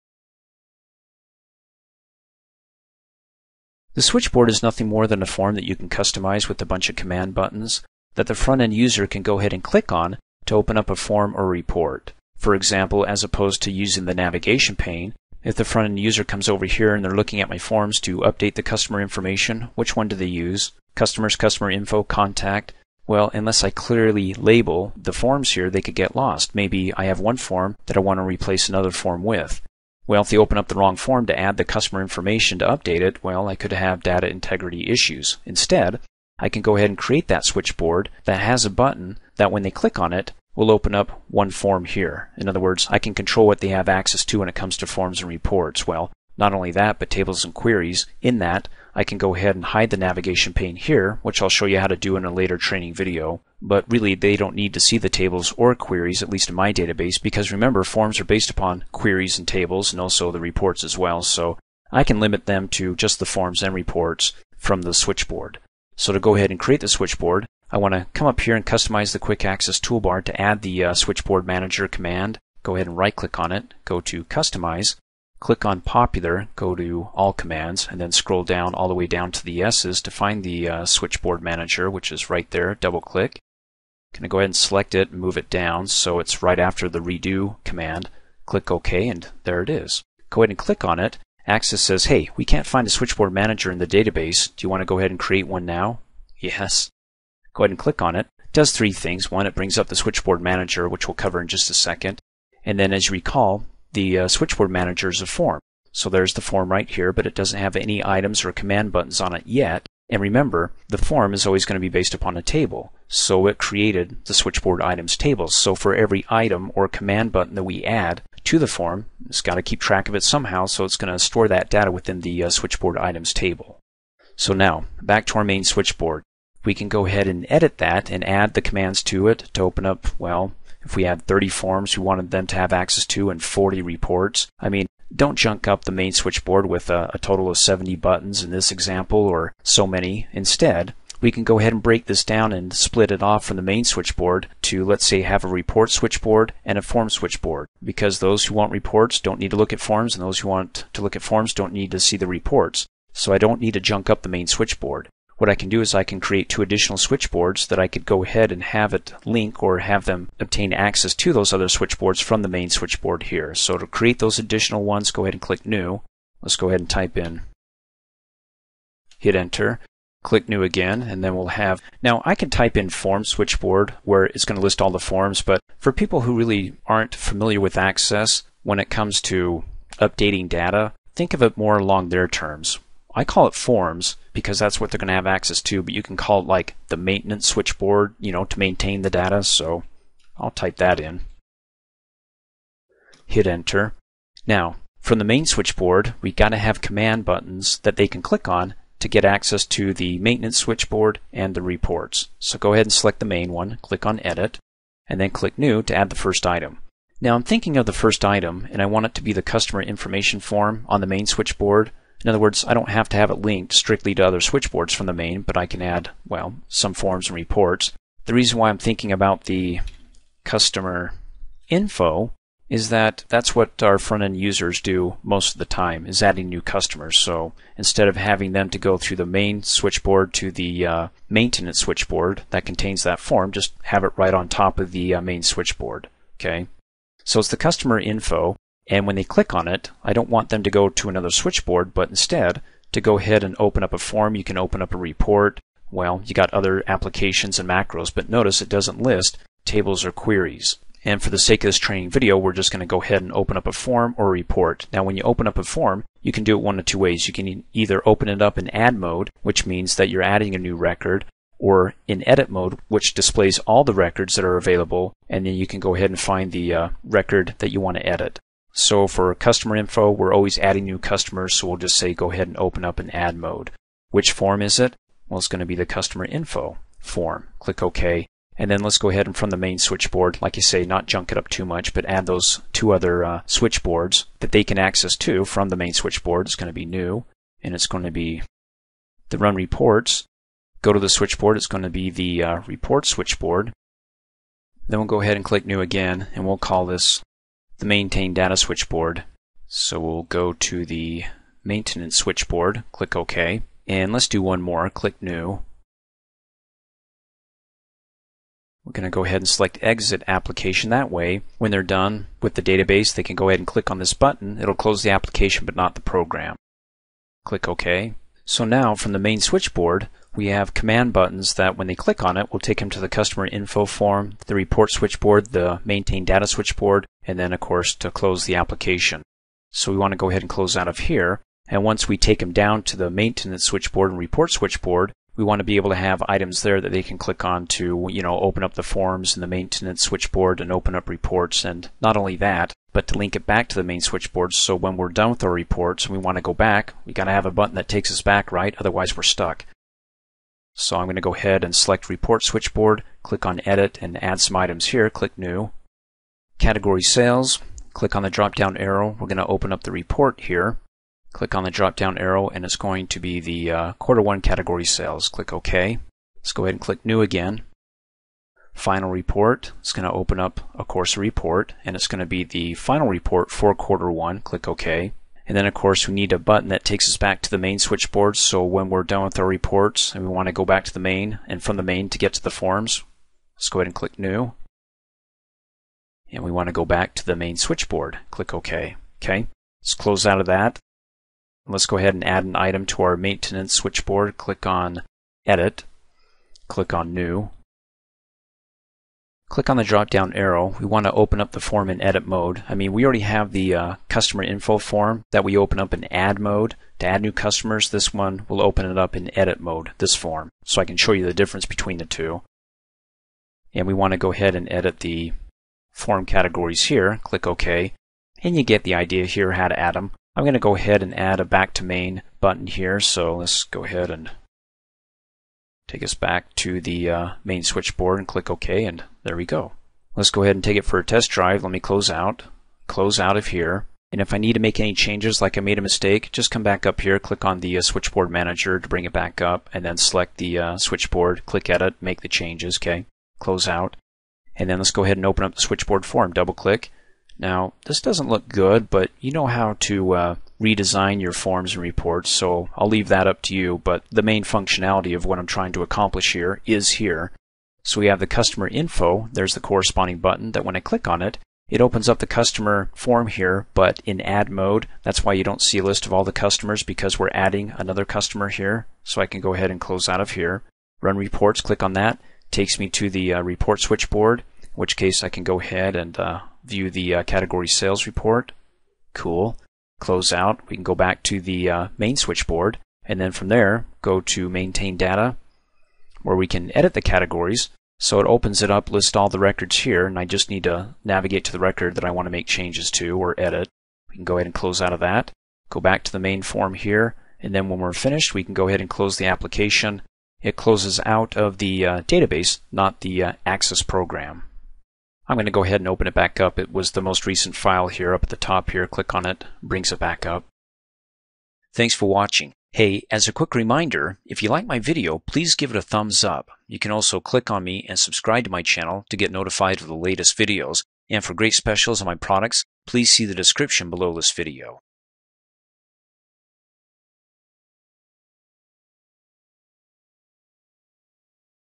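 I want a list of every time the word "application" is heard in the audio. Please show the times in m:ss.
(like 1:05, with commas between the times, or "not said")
4:06, 5:10, 5:15, 5:28, 8:19.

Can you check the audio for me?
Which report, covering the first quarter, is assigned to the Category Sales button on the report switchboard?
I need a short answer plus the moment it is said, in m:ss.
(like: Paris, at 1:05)
quarter one category sales, at 6:03.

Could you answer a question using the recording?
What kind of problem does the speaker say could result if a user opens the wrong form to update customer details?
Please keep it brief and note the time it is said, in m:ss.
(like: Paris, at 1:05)
data integrity issues, at 0:34.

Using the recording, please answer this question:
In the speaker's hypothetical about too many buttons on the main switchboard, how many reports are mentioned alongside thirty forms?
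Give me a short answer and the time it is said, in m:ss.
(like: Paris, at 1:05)
40, at 2:13.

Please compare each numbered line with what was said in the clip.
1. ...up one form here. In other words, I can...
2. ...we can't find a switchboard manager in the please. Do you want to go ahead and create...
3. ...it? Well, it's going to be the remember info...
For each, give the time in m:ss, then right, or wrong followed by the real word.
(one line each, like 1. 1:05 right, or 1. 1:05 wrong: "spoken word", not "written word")
1. 0:40 right
2. 1:32 wrong: "database", not "please"
3. 4:34 wrong: "customer", not "remember".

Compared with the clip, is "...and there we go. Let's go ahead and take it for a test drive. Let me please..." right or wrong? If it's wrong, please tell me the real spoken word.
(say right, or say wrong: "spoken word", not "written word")
wrong: "close", not "please".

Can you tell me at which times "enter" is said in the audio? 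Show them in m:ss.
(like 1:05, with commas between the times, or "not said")
2:49, 3:13.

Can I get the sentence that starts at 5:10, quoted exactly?
That way, when they're done with the database, they can go ahead and click on this button.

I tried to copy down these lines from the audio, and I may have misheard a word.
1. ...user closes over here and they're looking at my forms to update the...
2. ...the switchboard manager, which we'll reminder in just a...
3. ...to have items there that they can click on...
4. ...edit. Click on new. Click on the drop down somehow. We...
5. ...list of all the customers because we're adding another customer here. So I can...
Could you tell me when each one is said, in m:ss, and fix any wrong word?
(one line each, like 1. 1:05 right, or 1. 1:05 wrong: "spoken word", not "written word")
1. 0:15 wrong: "comes", not "closes"
2. 1:39 wrong: "cover", not "reminder"
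3. 5:35 right
4. 6:35 wrong: "arrow", not "somehow"
5. 7:45 right.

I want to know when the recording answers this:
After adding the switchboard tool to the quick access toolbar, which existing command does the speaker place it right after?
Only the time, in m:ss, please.
1:26.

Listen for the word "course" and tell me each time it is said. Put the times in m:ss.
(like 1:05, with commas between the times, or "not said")
5:27, 6:10, 6:15.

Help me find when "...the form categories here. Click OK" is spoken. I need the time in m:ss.
6:55.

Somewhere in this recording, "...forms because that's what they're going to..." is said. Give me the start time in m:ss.
3:03.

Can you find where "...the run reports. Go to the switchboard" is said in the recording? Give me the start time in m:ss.
4:49.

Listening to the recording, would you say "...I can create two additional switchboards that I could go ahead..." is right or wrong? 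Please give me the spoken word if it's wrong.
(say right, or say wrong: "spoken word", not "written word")
right.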